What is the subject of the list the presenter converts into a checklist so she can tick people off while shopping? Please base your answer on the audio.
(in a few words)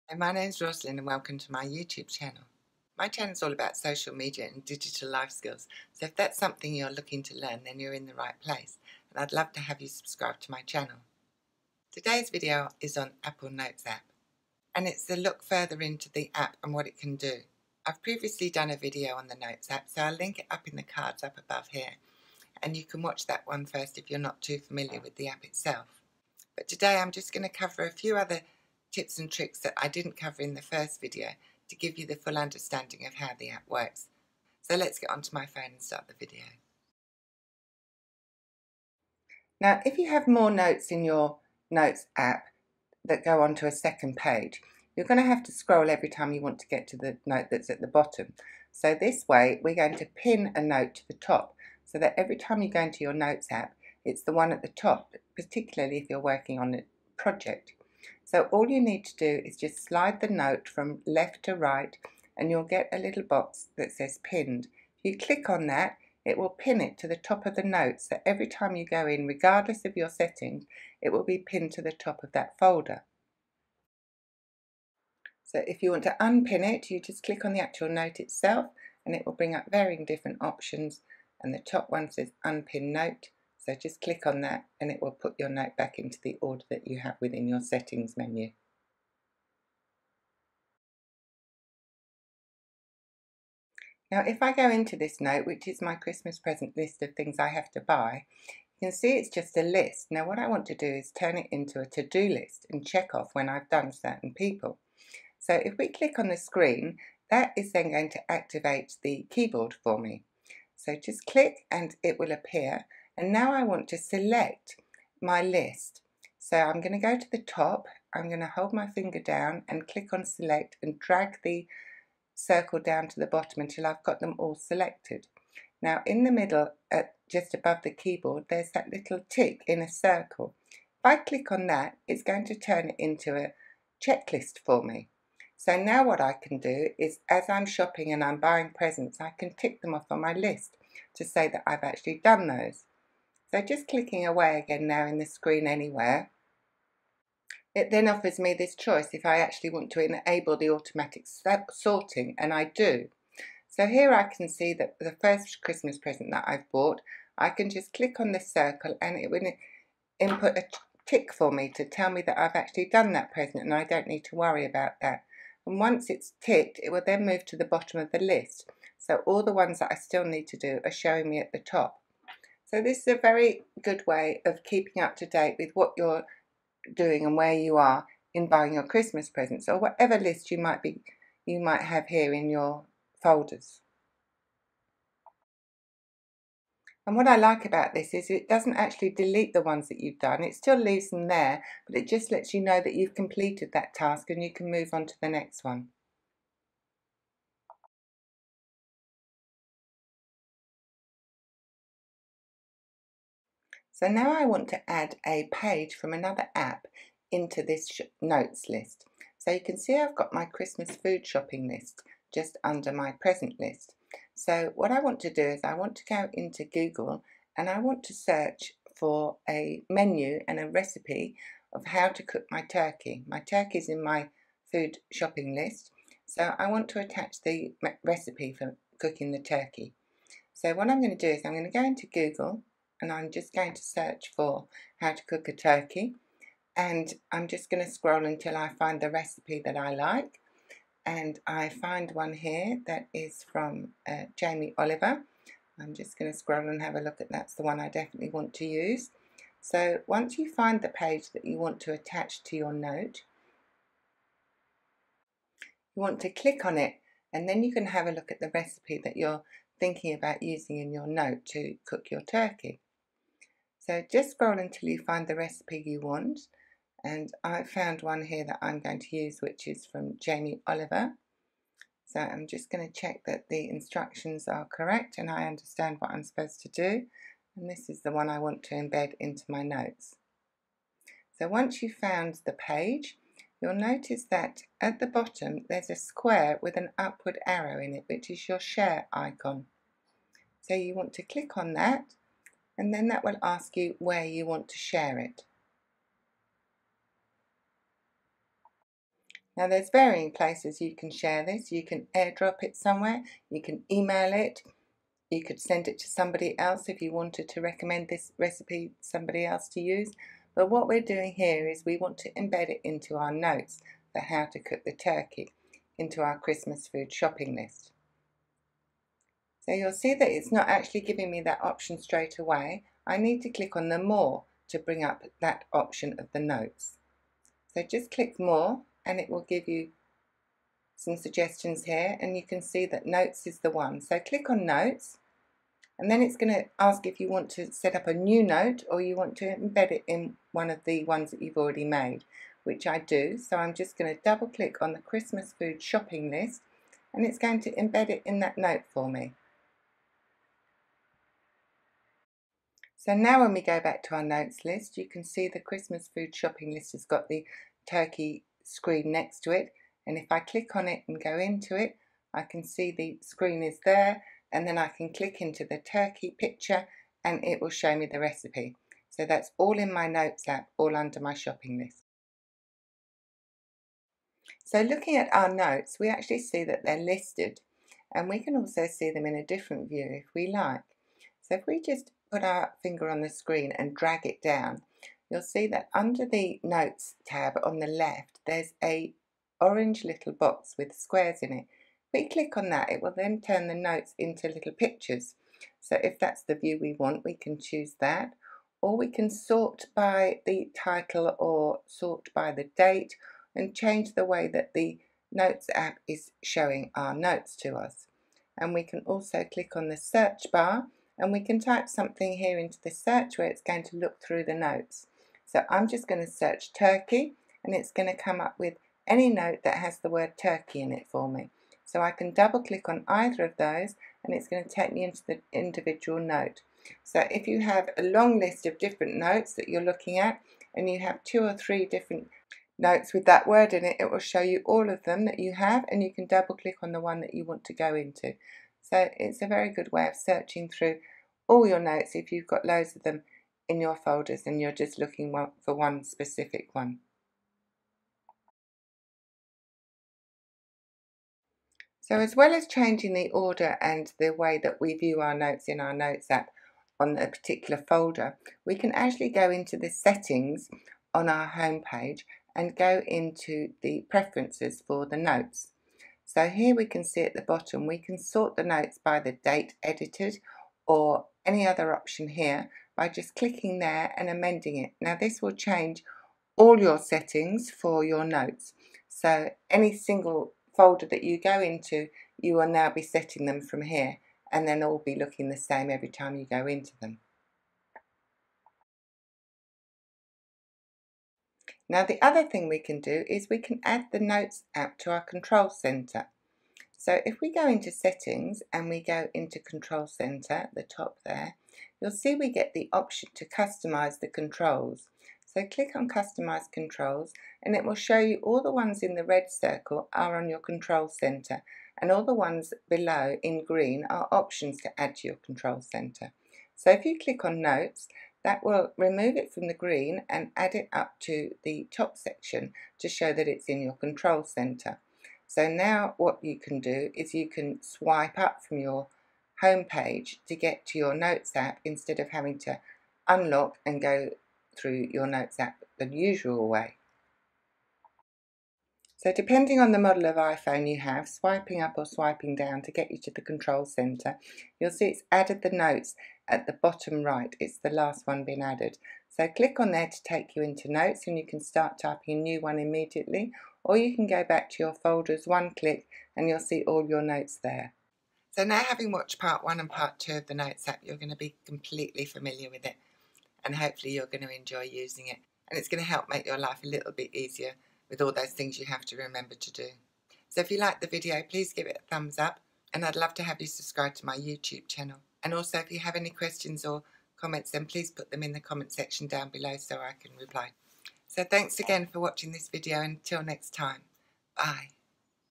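Christmas present list.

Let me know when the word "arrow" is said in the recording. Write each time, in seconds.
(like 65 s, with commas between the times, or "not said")
287 s.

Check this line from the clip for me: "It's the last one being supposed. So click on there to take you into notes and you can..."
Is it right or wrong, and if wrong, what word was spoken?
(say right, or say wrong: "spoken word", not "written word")
wrong: "added", not "supposed".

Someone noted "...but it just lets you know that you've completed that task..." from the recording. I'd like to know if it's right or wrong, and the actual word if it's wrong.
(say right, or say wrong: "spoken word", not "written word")
right.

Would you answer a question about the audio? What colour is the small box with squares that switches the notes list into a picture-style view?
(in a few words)
Orange.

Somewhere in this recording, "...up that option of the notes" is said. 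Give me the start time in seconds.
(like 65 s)
325 s.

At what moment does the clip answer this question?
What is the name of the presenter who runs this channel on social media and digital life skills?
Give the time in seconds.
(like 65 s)
0 s.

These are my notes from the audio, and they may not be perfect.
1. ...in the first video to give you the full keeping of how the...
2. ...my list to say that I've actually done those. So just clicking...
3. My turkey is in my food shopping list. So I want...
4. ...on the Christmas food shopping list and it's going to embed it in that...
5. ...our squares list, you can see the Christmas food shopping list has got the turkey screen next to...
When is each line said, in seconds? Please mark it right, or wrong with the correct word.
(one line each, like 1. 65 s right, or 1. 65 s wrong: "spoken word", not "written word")
1. 30 s wrong: "understanding", not "keeping"
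2. 140 s right
3. 223 s right
4. 344 s right
5. 354 s wrong: "notes", not "squares".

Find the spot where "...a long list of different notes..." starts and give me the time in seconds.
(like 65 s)
427 s.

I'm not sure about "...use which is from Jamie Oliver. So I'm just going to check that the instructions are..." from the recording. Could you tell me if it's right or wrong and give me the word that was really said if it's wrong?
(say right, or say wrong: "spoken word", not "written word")
right.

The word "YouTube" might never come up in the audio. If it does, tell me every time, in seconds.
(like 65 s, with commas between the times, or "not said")
1 s, 574 s.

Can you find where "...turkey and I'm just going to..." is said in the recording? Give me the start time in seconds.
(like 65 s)
235 s.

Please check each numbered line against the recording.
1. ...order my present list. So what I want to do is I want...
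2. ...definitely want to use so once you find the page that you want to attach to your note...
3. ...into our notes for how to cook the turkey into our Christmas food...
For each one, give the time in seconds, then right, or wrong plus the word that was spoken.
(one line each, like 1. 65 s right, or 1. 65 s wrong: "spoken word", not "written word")
1. 212 s wrong: "under", not "order"
2. 247 s right
3. 312 s right.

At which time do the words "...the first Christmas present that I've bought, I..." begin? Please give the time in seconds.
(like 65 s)
154 s.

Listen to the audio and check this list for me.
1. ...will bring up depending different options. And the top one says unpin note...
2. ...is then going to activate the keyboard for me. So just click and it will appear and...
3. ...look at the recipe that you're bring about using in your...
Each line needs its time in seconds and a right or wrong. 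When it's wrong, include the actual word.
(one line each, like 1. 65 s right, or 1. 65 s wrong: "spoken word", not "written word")
1. 79 s wrong: "varying", not "depending"
2. 107 s right
3. 258 s wrong: "thinking", not "bring".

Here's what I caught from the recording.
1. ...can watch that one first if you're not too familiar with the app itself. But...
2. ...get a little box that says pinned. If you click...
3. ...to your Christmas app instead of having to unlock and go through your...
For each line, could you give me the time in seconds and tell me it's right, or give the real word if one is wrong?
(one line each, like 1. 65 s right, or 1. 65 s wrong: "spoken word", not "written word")
1. 22 s right
2. 62 s right
3. 530 s wrong: "Notes", not "Christmas".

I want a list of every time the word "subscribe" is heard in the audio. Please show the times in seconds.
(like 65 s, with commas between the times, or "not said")
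9 s, 573 s.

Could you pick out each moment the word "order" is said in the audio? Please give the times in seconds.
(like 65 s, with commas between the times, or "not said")
86 s, 453 s.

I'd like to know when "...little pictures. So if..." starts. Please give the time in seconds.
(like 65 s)
394 s.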